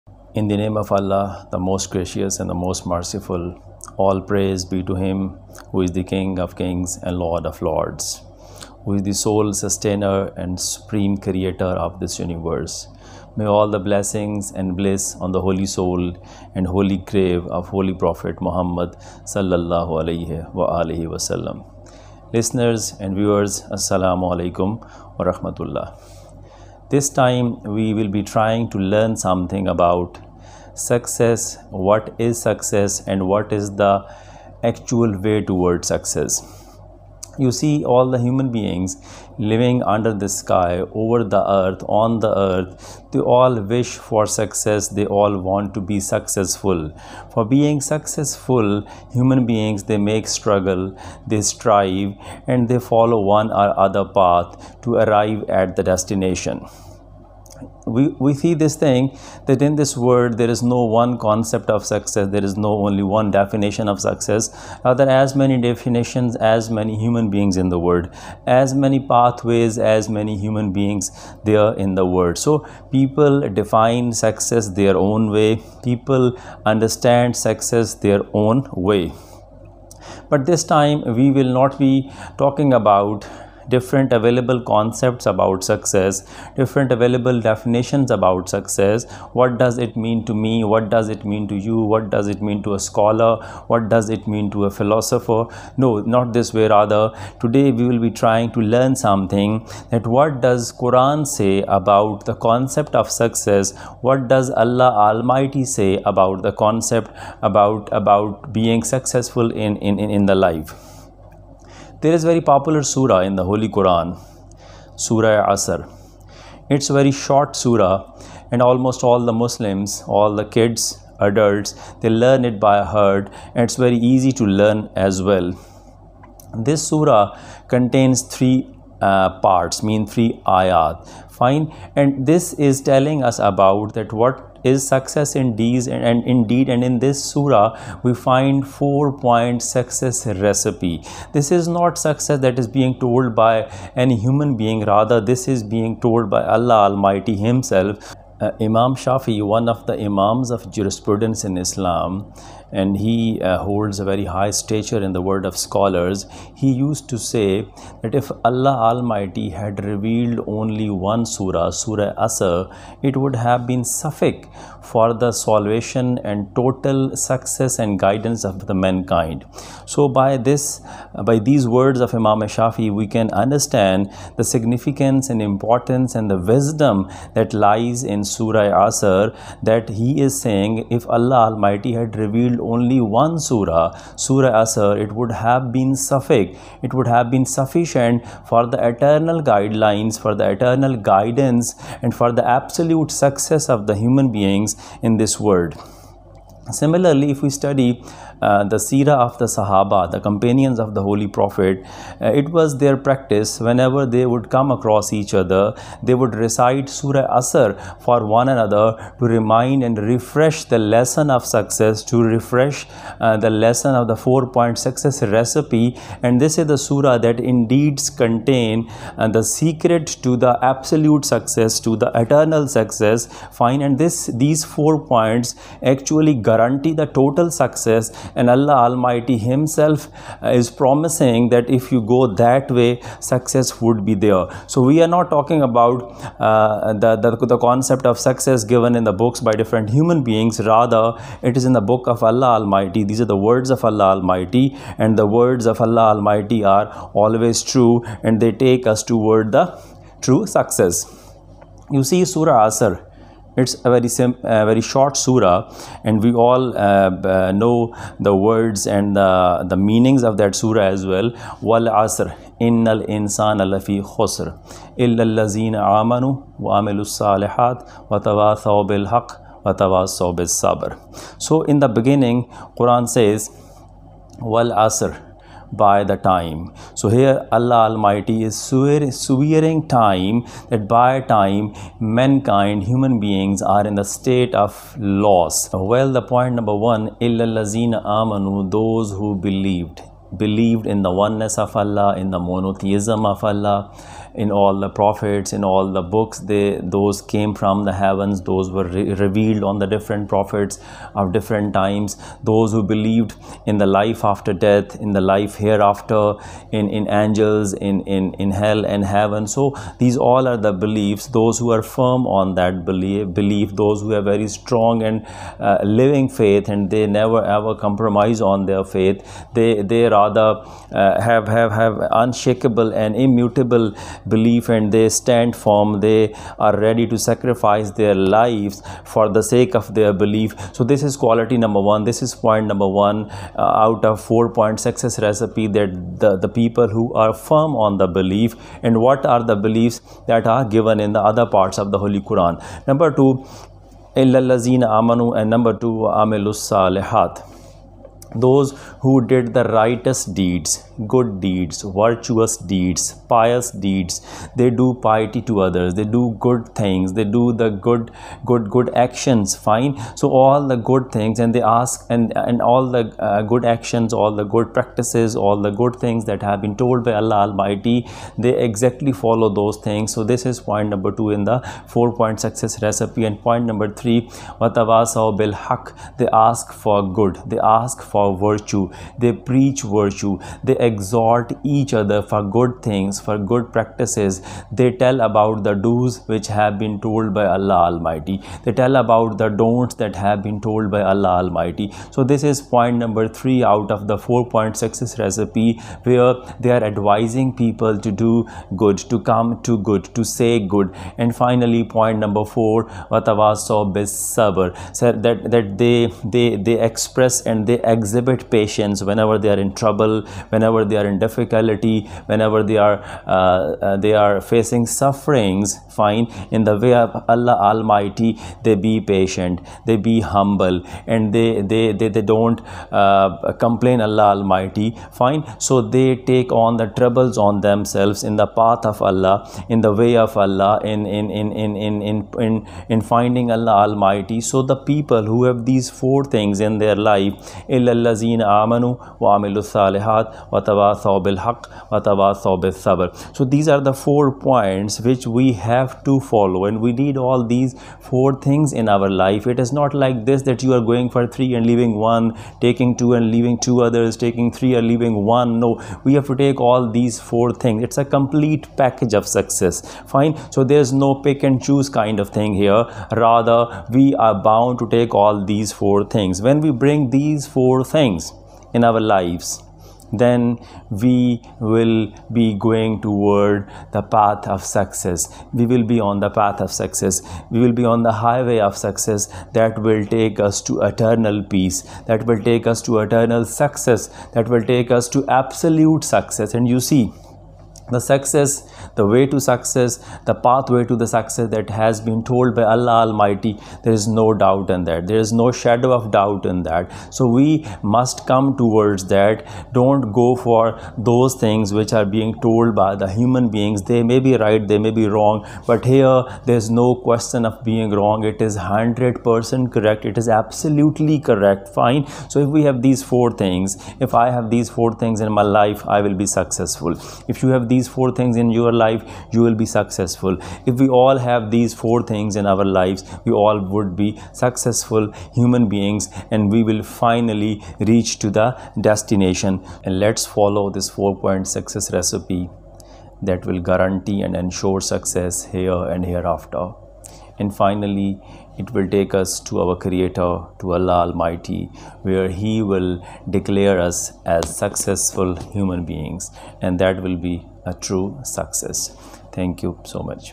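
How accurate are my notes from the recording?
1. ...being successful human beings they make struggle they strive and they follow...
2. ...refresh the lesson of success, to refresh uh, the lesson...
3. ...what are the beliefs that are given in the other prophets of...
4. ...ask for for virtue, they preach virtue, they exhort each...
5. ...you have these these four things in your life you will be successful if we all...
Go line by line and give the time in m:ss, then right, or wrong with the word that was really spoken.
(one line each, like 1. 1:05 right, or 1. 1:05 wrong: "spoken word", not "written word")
1. 0:47 right
2. 3:29 right
3. 5:38 wrong: "parts", not "prophets"
4. 6:17 right
5. 8:37 right.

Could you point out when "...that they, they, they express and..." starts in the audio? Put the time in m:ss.
6:45.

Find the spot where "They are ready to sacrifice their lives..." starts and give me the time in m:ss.
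5:25.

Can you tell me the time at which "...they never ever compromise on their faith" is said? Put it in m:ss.
5:16.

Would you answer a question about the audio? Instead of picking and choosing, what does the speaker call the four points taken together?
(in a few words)
a complete package of success.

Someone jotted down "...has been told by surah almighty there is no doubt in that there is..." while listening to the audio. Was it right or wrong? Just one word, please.
wrong.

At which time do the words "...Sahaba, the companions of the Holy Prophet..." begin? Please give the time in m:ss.
3:19.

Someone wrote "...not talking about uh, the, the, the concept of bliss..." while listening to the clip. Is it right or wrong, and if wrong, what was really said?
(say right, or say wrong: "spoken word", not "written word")
wrong: "success", not "bliss".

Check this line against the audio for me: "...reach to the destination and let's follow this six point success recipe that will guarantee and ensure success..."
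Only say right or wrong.
wrong.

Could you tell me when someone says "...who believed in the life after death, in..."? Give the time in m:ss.
5:02.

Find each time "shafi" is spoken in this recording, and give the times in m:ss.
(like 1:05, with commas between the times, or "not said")
2:29, 2:52.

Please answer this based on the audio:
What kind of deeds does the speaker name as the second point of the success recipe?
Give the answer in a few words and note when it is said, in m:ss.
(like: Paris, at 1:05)
righteous deeds, at 5:49.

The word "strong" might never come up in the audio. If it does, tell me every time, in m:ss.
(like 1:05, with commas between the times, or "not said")
5:14.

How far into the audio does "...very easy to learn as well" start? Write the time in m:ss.
2:03.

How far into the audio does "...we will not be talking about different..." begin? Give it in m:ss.
1:21.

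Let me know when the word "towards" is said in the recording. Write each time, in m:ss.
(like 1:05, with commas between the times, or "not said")
0:35, 4:09, 7:53, 8:18.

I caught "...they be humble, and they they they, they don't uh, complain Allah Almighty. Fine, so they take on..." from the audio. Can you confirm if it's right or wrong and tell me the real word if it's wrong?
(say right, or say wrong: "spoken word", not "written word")
right.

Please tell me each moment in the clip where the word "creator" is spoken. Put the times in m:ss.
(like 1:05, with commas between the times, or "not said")
0:11, 8:59.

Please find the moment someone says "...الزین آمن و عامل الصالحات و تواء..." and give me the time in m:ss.
4:25.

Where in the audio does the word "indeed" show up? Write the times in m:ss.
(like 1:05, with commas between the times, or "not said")
2:16, 3:37.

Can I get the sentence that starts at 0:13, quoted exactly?
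May all the blessings and bliss on the holy soul and holy grave of Holy Prophet Muhammad sallallahu alaihi wa alihi wasallam.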